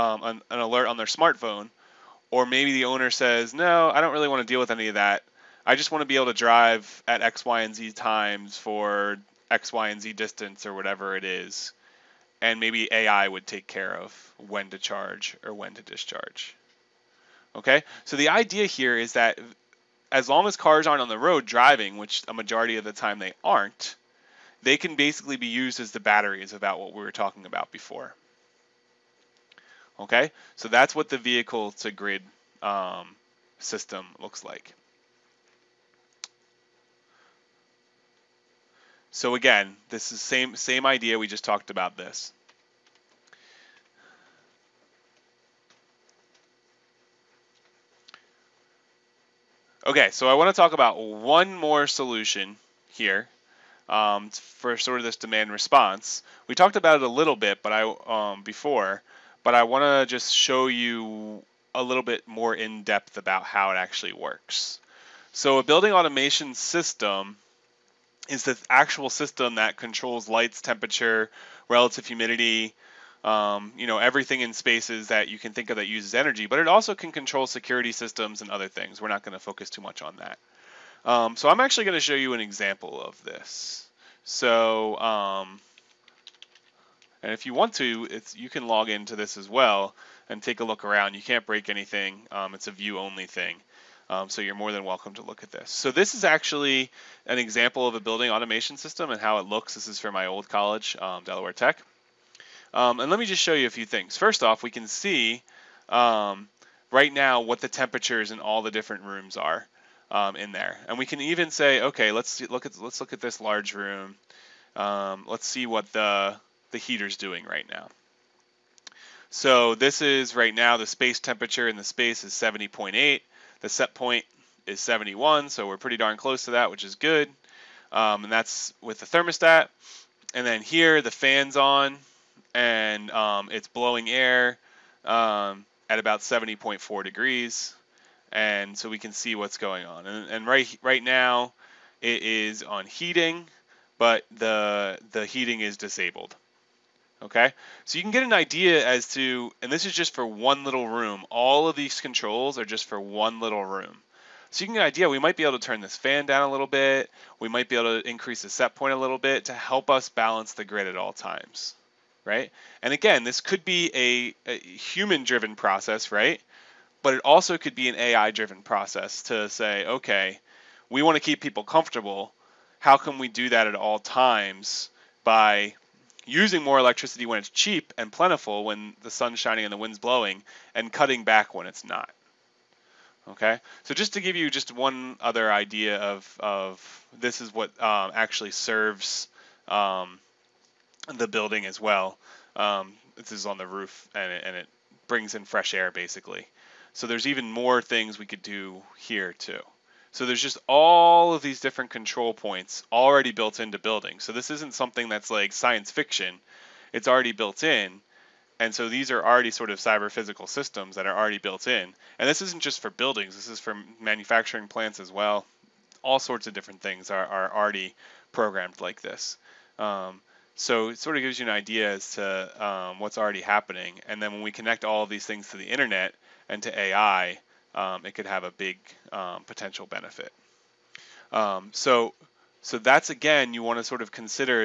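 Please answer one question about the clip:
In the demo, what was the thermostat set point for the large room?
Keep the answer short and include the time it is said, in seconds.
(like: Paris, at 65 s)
71, at 124 s.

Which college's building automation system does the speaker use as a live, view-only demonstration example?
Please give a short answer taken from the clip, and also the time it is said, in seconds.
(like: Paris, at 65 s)
Delaware Tech, at 101 s.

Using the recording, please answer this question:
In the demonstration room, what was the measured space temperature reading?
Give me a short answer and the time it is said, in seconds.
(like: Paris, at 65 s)
70.8, at 122 s.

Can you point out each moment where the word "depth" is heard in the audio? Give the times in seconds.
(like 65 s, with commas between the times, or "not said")
62 s.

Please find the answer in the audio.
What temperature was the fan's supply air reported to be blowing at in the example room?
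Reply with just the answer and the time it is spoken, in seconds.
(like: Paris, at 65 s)
70.4 degrees, at 136 s.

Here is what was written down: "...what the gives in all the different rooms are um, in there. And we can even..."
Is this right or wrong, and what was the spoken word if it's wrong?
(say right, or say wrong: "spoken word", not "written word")
wrong: "temperatures", not "gives".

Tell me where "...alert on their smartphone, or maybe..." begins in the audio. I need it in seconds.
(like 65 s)
0 s.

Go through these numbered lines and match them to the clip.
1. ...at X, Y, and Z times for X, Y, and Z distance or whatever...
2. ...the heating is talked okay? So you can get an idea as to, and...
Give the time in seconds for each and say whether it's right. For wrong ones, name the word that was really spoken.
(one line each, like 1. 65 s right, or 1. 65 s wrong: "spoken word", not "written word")
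1. 7 s right
2. 145 s wrong: "disabled", not "talked".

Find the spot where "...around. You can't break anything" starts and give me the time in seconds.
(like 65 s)
90 s.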